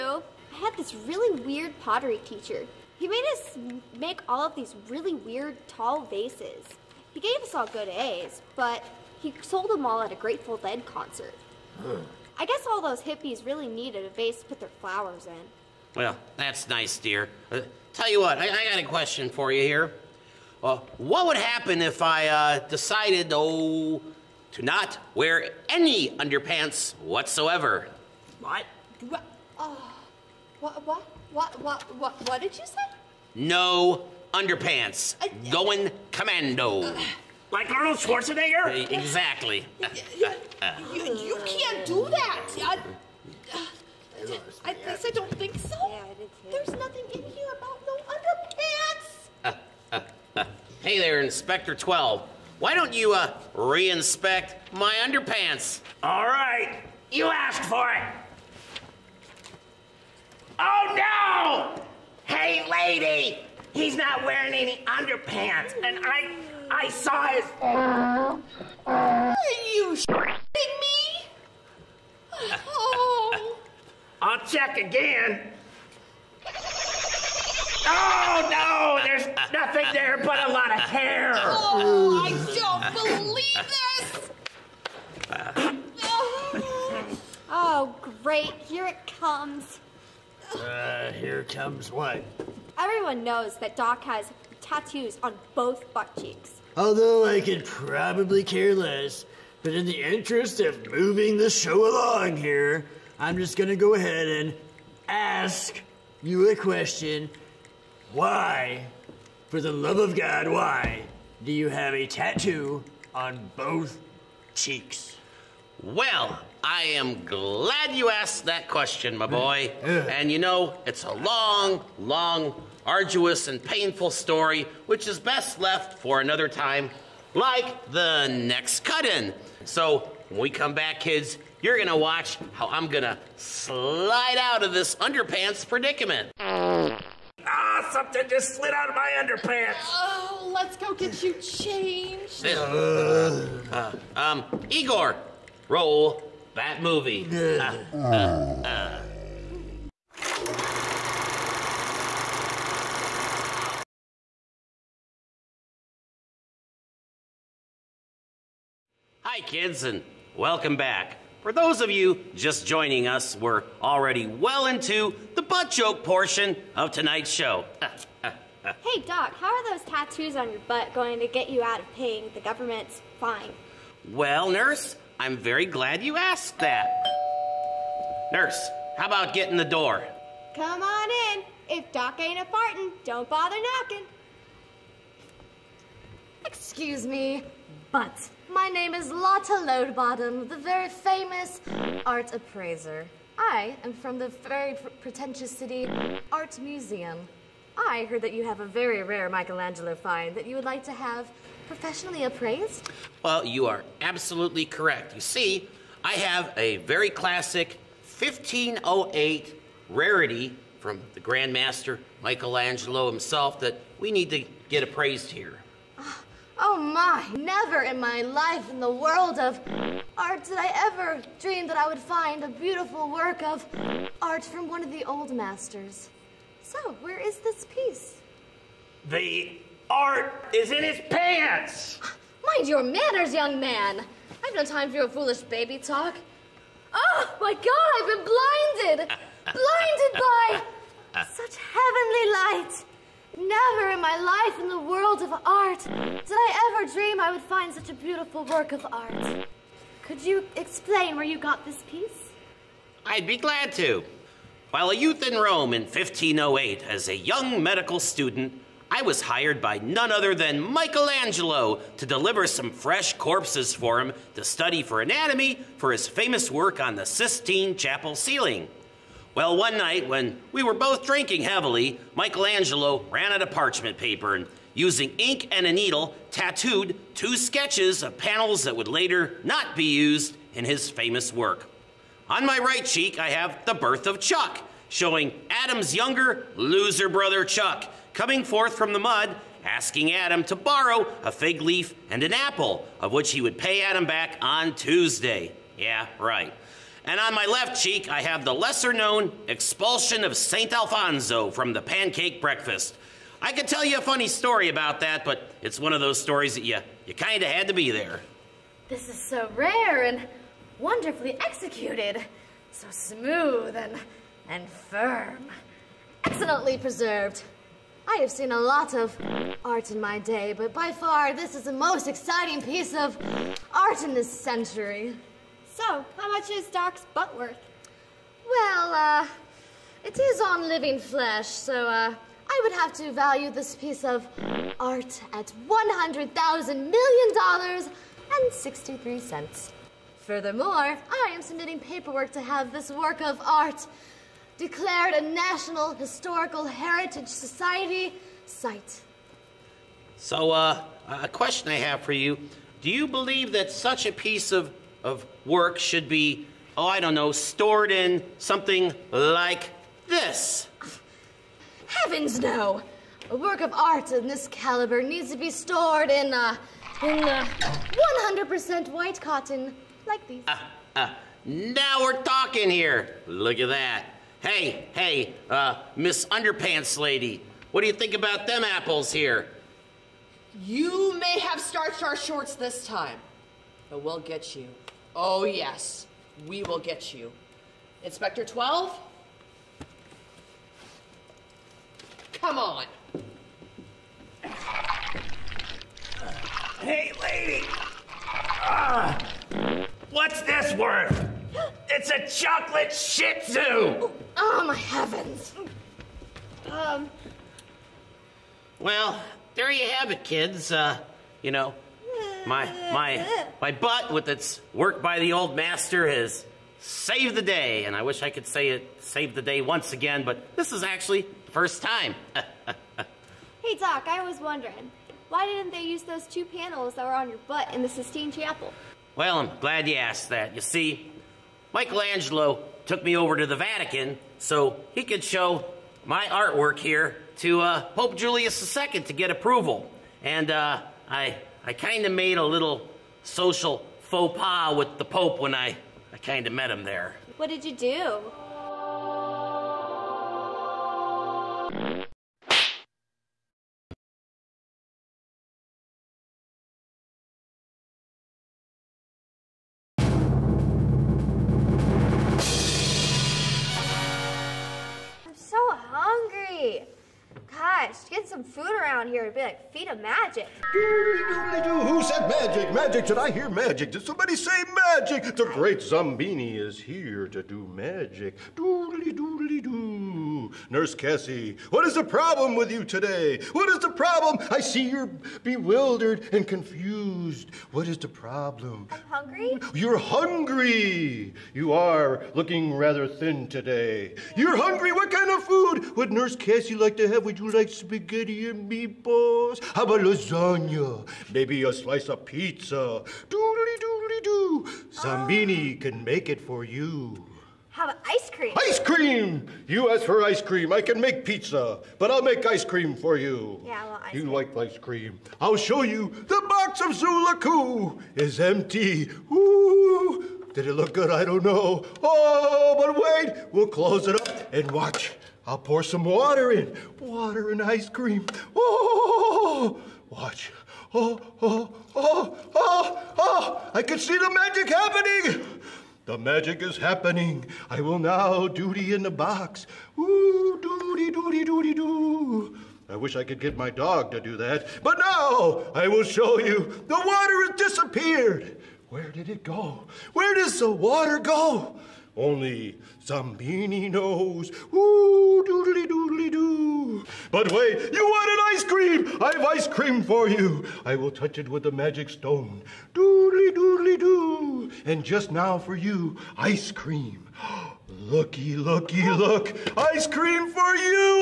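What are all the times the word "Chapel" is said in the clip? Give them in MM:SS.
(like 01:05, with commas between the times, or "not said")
04:27, 07:08.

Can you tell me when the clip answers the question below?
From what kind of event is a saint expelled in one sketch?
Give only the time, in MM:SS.
05:01.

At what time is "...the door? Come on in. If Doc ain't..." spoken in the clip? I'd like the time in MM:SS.
02:59.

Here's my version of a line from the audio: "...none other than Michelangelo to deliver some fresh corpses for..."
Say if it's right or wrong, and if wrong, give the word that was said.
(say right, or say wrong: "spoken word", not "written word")
right.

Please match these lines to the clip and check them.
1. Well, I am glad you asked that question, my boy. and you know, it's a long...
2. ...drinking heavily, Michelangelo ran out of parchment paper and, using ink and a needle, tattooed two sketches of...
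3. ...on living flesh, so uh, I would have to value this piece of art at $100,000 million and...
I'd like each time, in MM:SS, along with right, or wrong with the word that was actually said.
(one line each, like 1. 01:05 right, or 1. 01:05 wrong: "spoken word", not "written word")
1. 01:55 right
2. 04:31 right
3. 05:30 right.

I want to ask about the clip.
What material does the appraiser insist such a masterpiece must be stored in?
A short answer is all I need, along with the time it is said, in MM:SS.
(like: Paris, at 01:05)
100% white cotton, at 06:08.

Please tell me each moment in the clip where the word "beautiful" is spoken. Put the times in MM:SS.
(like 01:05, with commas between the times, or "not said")
03:42, 04:07.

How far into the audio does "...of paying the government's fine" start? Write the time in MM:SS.
02:51.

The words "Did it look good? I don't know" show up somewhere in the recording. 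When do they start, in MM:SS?
08:40.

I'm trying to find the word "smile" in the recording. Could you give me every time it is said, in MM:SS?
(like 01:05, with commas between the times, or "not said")
not said.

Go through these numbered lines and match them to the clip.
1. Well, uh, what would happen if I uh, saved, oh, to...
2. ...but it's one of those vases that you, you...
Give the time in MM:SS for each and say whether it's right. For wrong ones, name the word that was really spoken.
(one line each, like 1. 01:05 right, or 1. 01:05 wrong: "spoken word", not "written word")
1. 00:20 wrong: "decided", not "saved"
2. 05:05 wrong: "stories", not "vases".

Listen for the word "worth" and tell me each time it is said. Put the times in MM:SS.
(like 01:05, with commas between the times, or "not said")
05:27, 06:40.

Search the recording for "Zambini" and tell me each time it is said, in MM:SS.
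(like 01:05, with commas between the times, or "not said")
08:24, 09:13.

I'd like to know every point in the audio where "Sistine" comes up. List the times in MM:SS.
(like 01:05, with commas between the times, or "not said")
04:27, 07:07.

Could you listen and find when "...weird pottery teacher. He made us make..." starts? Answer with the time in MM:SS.
00:01.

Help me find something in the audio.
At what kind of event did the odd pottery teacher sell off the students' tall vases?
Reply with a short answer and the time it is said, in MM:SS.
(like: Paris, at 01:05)
Grateful Dead concert, at 00:10.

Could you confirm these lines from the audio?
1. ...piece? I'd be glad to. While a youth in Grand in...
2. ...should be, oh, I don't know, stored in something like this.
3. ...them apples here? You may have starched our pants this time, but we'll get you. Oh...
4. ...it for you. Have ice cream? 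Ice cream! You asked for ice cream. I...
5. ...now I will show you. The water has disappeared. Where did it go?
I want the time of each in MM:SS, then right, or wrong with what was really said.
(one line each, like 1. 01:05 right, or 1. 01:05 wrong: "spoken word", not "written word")
1. 04:11 wrong: "Rome", not "Grand"
2. 05:55 right
3. 06:18 wrong: "shorts", not "pants"
4. 08:26 right
5. 09:04 right.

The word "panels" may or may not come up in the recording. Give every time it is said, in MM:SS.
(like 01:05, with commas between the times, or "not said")
04:38, 07:06.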